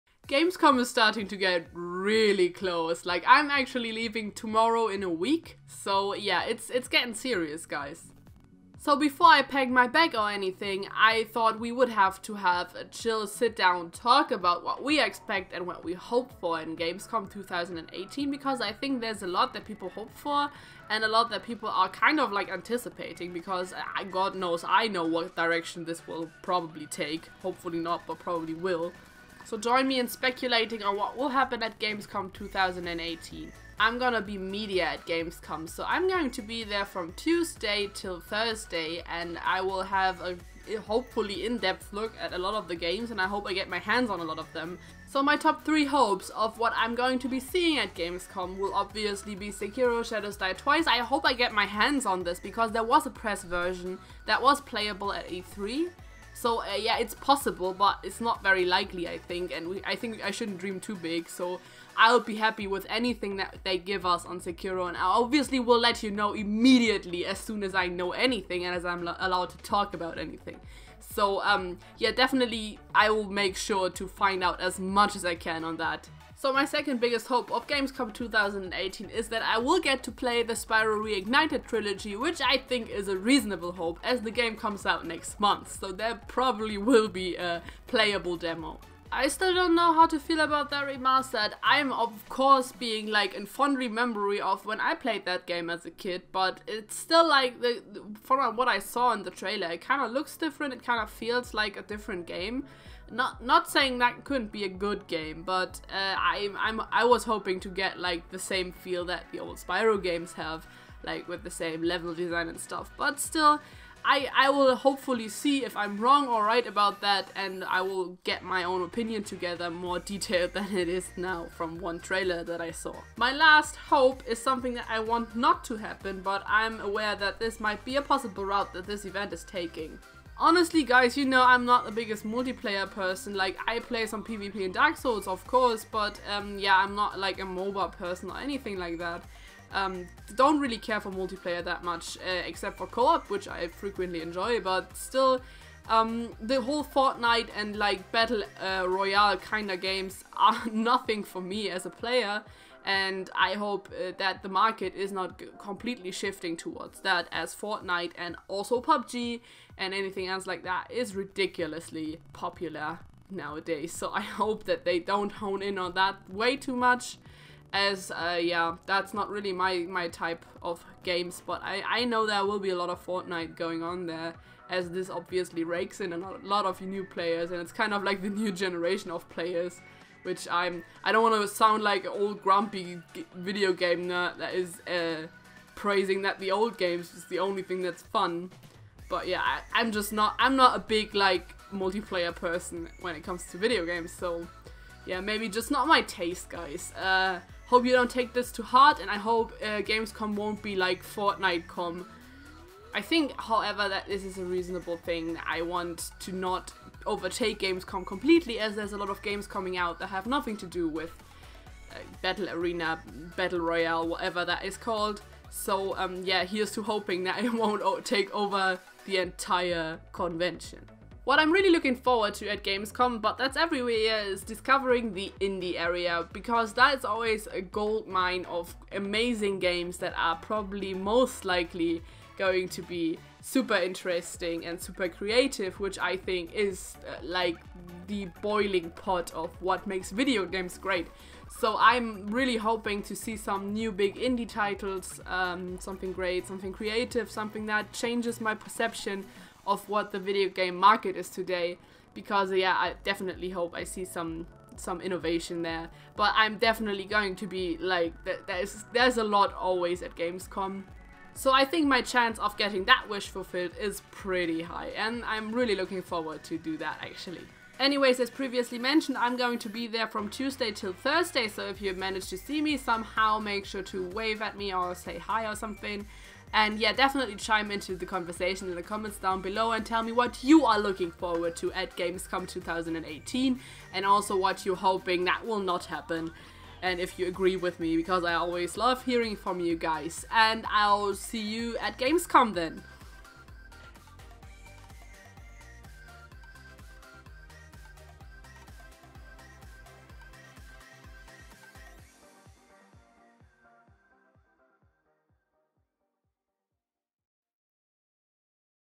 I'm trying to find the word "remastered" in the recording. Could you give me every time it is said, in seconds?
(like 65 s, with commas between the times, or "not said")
90 s.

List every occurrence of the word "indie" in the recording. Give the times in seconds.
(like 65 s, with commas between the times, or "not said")
225 s, 244 s.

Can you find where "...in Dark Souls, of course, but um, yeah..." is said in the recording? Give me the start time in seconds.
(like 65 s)
134 s.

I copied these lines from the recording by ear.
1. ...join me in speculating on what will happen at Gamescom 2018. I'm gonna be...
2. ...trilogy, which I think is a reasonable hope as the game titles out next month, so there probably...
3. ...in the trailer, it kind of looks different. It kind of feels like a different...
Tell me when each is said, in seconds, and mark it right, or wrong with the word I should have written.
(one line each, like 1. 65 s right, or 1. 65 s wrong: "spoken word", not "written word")
1. 29 s right
2. 81 s wrong: "comes", not "titles"
3. 99 s right.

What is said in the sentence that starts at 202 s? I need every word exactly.
I think, however, that this is a reasonable thing.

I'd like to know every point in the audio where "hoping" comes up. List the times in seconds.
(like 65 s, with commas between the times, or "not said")
107 s, 216 s, 242 s, 284 s.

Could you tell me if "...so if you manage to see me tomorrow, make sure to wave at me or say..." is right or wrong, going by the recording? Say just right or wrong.
wrong.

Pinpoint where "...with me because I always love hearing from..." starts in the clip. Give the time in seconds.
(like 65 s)
287 s.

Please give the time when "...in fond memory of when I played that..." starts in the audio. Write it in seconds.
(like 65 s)
93 s.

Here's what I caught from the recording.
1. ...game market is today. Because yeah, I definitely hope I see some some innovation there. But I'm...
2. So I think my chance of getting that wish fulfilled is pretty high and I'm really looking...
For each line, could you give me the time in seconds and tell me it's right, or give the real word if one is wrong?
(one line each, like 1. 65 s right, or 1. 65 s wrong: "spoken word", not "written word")
1. 250 s right
2. 261 s right.